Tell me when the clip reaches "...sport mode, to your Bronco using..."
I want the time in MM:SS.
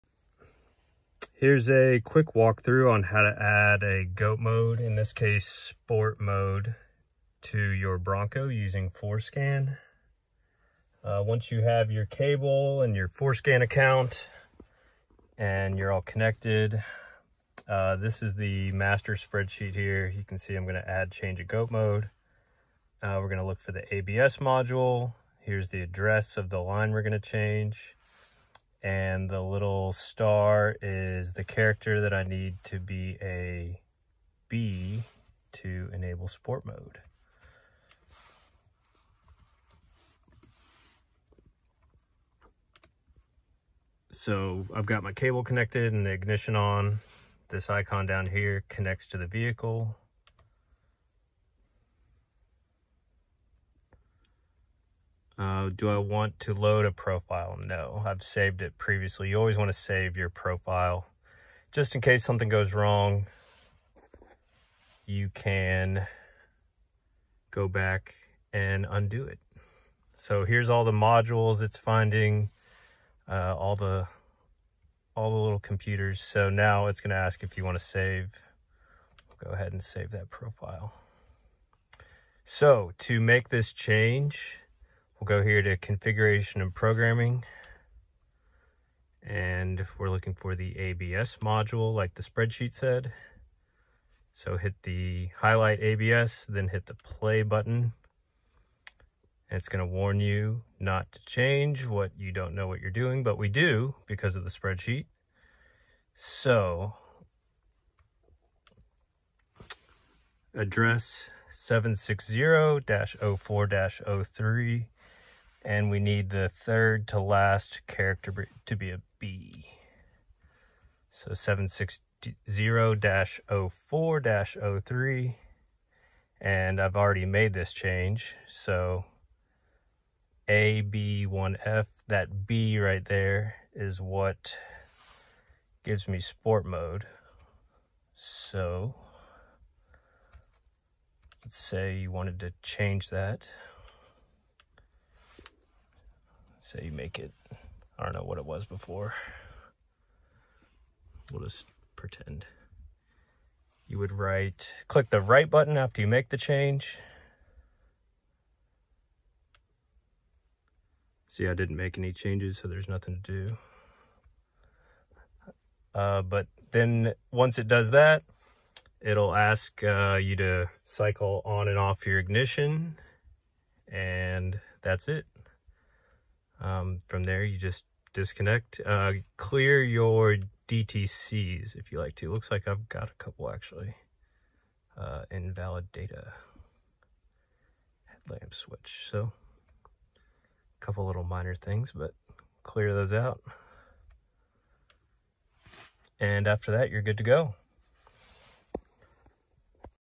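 00:05.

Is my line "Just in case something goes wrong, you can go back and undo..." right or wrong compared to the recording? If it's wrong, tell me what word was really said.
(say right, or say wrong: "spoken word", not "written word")
right.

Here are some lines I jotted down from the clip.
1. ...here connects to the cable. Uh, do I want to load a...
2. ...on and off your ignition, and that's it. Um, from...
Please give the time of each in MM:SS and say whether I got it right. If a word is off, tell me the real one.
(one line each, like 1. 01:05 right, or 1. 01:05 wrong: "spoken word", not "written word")
1. 00:48 wrong: "vehicle", not "cable"
2. 02:51 right.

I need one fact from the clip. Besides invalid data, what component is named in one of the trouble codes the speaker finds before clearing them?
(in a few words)
Headlamp switch.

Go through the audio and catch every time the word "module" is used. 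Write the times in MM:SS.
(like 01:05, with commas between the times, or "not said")
00:24, 01:10, 01:31.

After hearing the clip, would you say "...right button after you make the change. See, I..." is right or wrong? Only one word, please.
right.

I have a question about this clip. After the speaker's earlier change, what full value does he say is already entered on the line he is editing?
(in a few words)
AB1F.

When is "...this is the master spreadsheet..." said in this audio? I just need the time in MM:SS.
00:17.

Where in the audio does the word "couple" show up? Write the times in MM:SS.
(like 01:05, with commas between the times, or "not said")
03:03, 03:10.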